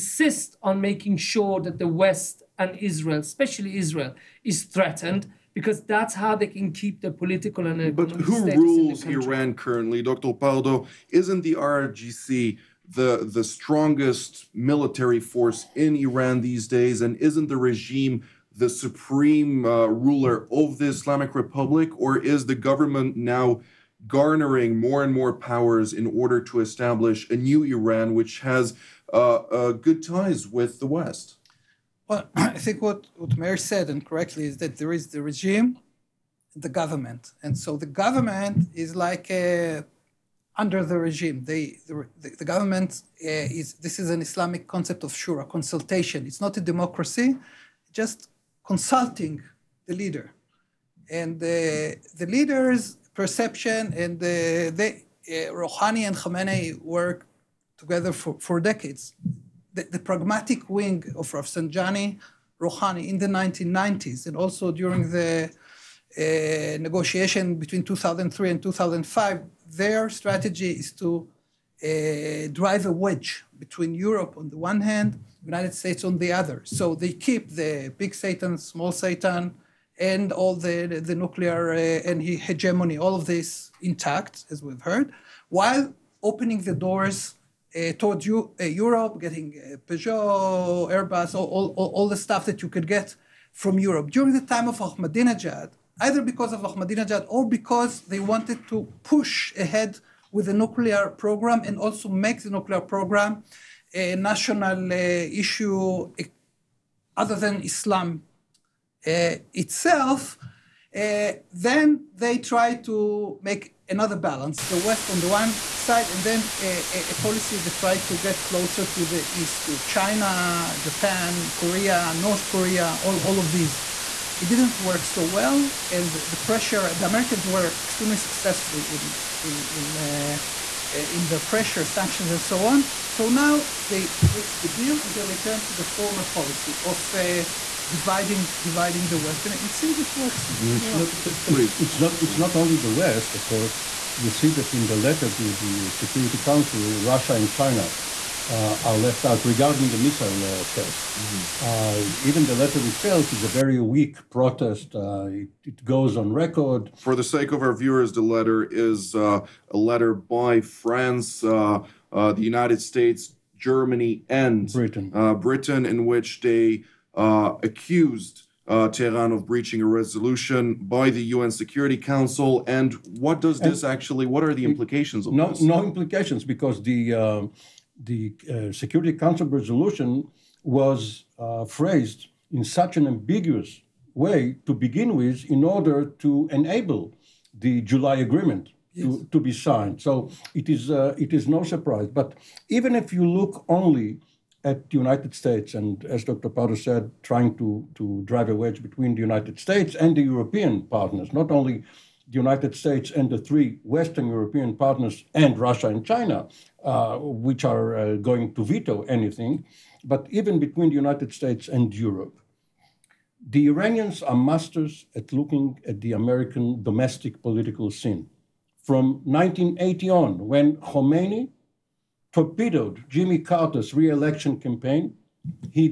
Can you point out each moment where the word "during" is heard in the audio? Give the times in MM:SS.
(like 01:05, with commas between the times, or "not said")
01:04, 01:34.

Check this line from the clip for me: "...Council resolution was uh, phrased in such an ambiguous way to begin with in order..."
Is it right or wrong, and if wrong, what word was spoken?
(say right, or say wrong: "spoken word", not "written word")
right.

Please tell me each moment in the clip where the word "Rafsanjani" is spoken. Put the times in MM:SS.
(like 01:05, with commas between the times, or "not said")
01:01.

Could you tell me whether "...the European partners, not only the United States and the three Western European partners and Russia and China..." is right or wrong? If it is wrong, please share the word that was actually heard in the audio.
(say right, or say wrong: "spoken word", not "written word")
right.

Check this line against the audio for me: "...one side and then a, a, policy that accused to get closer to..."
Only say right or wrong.
wrong.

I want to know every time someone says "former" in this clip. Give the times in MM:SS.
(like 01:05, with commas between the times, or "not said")
02:15.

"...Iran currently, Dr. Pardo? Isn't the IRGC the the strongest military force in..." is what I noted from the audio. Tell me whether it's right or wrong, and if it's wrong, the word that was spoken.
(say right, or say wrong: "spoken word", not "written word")
right.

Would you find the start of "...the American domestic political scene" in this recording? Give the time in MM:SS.
03:36.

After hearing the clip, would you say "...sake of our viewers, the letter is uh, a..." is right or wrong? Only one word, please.
right.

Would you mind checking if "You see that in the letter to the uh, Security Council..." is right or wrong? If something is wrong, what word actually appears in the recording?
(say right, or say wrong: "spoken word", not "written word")
right.